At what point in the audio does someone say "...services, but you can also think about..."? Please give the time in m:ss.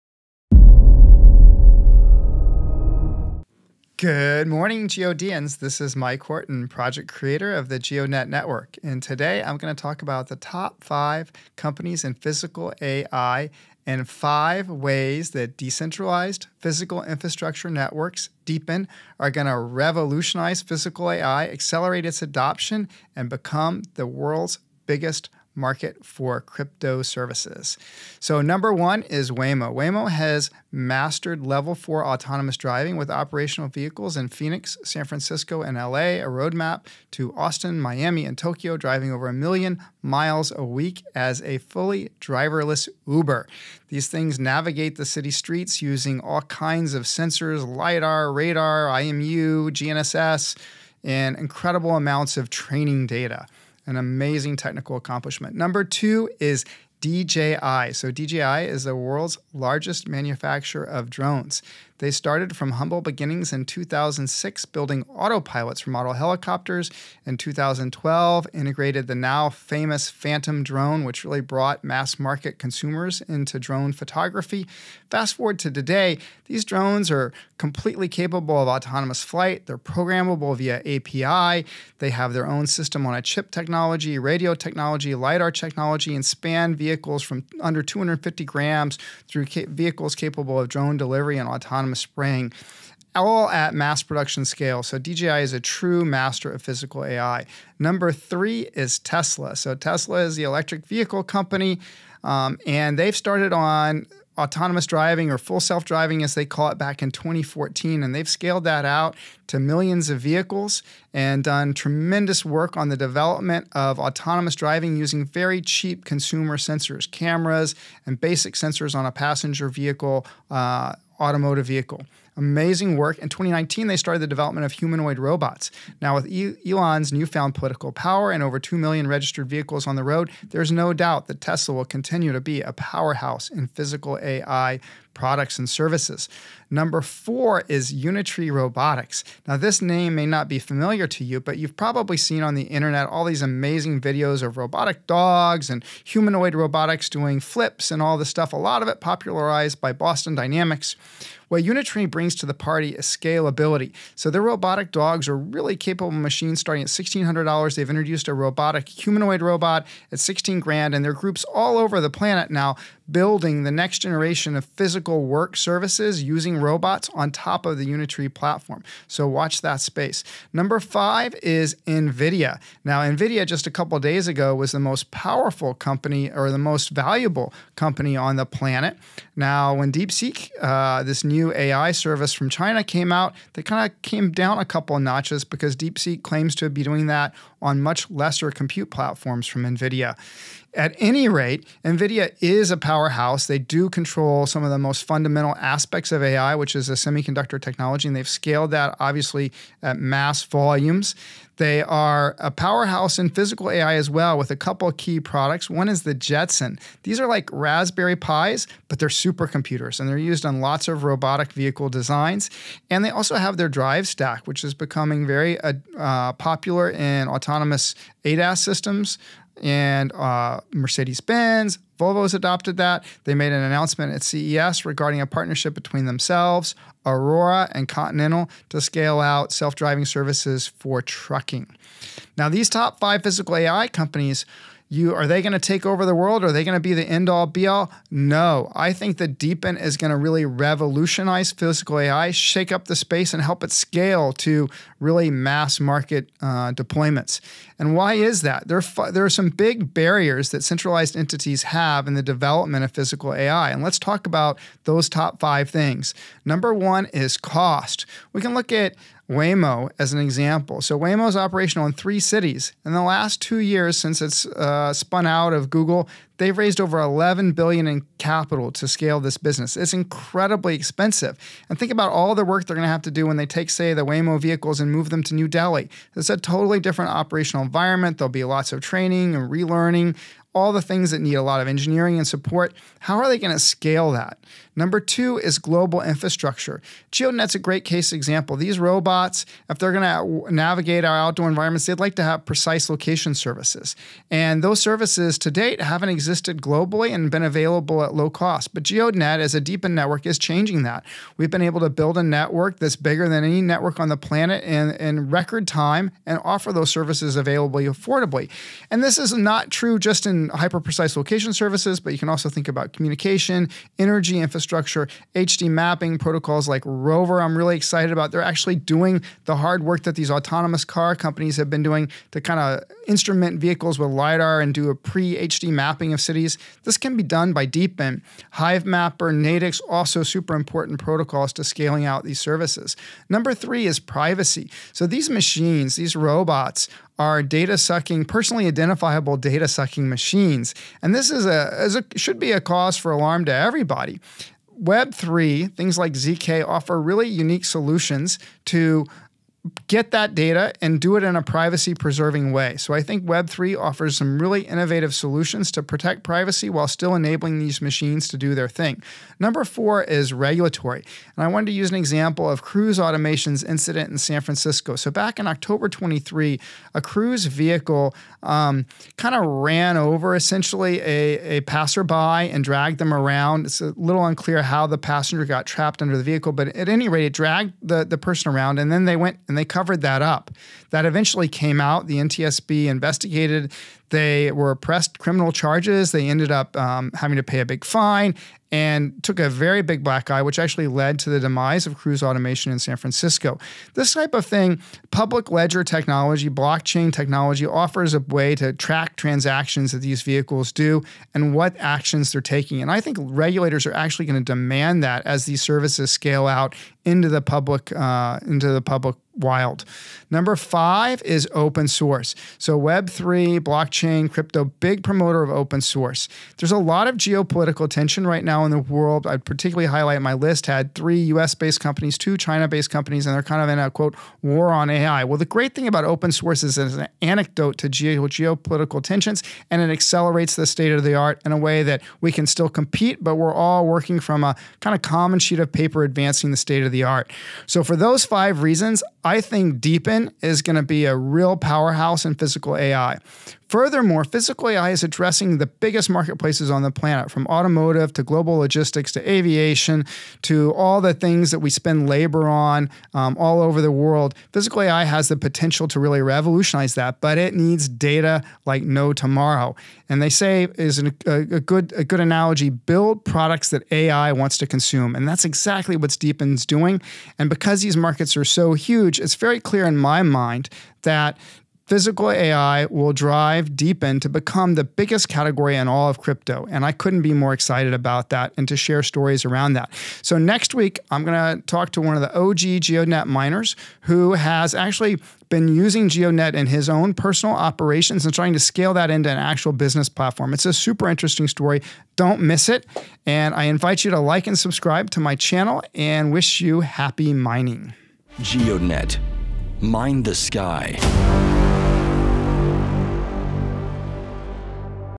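5:11.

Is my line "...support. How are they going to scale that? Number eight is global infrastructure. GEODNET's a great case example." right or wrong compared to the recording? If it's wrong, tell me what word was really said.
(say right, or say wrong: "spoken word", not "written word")
wrong: "two", not "eight".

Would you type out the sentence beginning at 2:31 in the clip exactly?
What Unitree brings to the party is scalability.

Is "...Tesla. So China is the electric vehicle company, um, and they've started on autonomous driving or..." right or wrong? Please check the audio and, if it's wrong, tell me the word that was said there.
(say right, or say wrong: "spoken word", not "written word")
wrong: "Tesla", not "China".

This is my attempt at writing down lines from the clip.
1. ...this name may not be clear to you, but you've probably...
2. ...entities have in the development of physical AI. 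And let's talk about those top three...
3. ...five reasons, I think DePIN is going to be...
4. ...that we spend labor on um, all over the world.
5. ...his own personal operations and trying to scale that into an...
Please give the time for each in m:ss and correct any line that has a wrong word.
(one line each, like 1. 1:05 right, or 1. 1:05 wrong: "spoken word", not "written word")
1. 2:19 wrong: "familiar", not "clear"
2. 4:11 wrong: "five", not "three"
3. 7:18 right
4. 7:31 right
5. 8:06 right.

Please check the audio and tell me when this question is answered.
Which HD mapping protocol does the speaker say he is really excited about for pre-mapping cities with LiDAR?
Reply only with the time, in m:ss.
5:16.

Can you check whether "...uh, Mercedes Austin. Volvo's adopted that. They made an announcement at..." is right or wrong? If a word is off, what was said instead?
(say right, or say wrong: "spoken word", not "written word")
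wrong: "Benz", not "Austin".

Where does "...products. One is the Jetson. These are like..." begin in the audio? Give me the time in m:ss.
3:25.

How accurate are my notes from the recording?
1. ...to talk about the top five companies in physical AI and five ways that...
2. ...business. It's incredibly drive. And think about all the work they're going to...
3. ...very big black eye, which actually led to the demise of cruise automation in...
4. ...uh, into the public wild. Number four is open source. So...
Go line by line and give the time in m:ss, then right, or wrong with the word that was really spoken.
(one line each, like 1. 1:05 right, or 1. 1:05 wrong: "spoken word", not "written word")
1. 0:09 right
2. 4:29 wrong: "expensive", not "drive"
3. 6:29 right
4. 6:47 wrong: "five", not "four".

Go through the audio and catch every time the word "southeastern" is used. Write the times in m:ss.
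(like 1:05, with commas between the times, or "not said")
not said.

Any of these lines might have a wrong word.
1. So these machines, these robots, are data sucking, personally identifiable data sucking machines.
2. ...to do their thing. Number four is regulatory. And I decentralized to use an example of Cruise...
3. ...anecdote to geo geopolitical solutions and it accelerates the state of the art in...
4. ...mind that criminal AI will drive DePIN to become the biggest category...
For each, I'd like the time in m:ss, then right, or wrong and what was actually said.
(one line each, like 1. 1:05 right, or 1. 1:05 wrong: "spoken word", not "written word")
1. 5:34 right
2. 5:58 wrong: "wanted", not "decentralized"
3. 7:07 wrong: "tensions", not "solutions"
4. 7:50 wrong: "physical", not "criminal".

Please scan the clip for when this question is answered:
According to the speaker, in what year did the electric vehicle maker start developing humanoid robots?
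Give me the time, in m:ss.
2:03.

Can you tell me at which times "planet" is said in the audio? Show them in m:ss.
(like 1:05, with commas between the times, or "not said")
2:42, 2:58, 5:04, 7:26.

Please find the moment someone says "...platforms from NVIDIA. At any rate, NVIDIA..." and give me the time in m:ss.
3:08.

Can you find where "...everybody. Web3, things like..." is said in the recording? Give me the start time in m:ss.
5:43.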